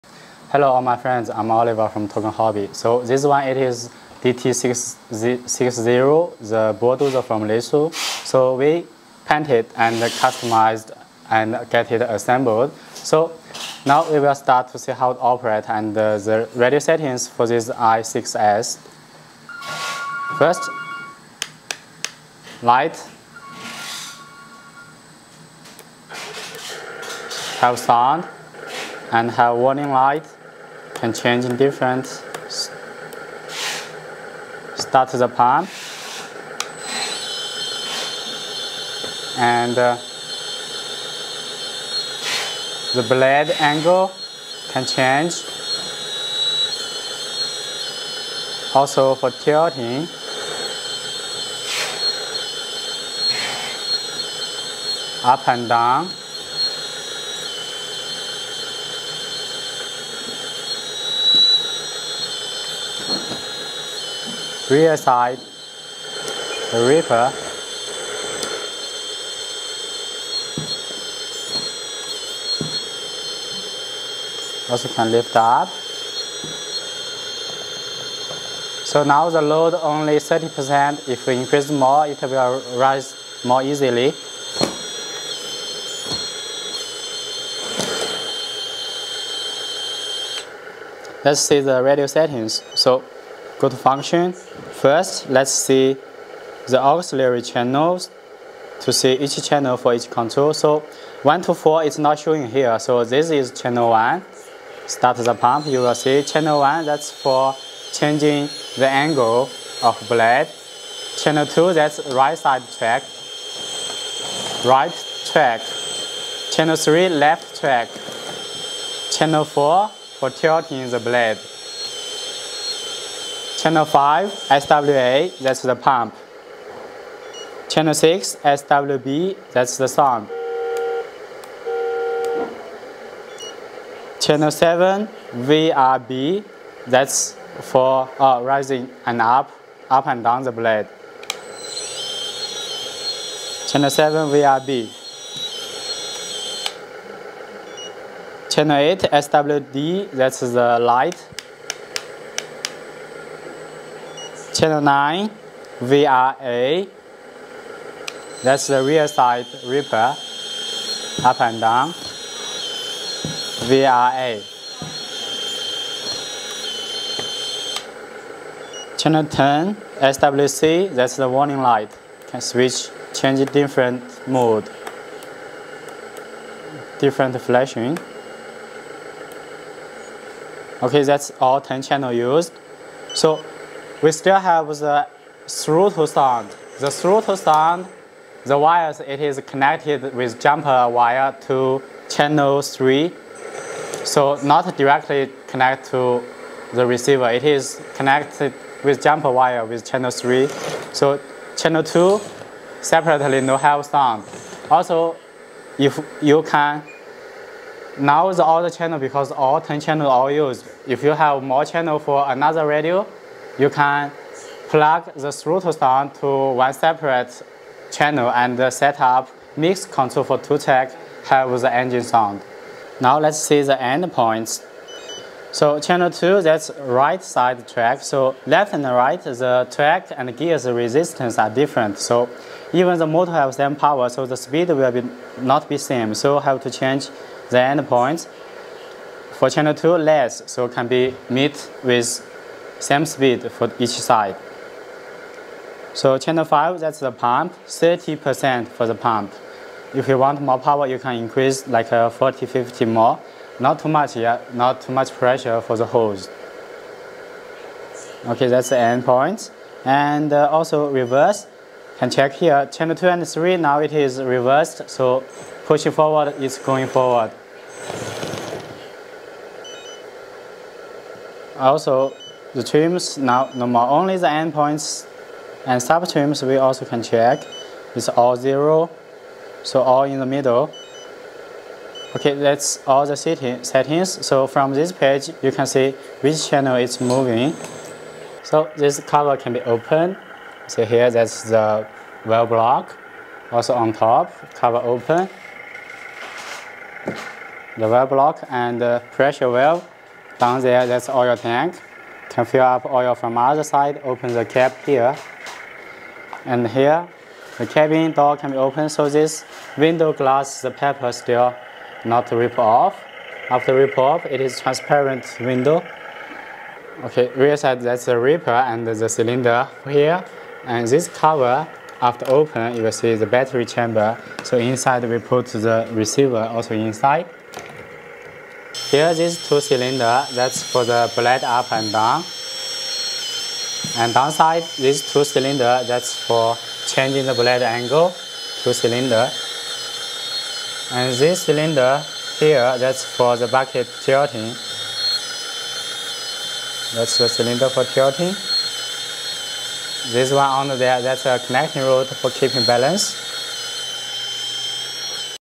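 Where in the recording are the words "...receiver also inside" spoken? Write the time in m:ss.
5:25.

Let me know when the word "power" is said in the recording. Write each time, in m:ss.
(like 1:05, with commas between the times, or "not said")
3:53, 4:10.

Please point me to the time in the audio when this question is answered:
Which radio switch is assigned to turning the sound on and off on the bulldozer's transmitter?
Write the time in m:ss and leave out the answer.
2:08.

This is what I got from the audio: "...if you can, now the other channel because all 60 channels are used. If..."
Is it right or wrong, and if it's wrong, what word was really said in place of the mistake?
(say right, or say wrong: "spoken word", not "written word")
wrong: "10", not "60".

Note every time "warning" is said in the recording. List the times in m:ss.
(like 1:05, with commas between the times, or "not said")
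0:29, 2:51.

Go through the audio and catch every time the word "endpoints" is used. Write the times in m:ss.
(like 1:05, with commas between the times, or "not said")
4:34.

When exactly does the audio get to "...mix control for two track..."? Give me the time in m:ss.
3:39.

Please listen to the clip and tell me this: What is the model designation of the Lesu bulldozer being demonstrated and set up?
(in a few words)
DT660.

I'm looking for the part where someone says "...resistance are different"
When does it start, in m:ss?
3:50.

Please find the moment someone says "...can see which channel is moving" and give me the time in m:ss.
4:45.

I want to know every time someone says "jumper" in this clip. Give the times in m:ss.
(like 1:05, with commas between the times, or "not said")
3:10, 3:19.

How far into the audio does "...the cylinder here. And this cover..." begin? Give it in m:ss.
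5:18.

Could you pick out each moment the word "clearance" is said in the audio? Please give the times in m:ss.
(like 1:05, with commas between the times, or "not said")
not said.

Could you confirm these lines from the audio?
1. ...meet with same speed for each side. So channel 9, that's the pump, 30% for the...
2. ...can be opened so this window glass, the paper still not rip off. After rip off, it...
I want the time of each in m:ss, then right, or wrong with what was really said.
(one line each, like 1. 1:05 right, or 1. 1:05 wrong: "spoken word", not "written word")
1. 4:01 wrong: "5", not "9"
2. 5:08 right.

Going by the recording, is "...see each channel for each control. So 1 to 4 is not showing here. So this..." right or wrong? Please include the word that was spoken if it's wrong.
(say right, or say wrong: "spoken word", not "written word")
right.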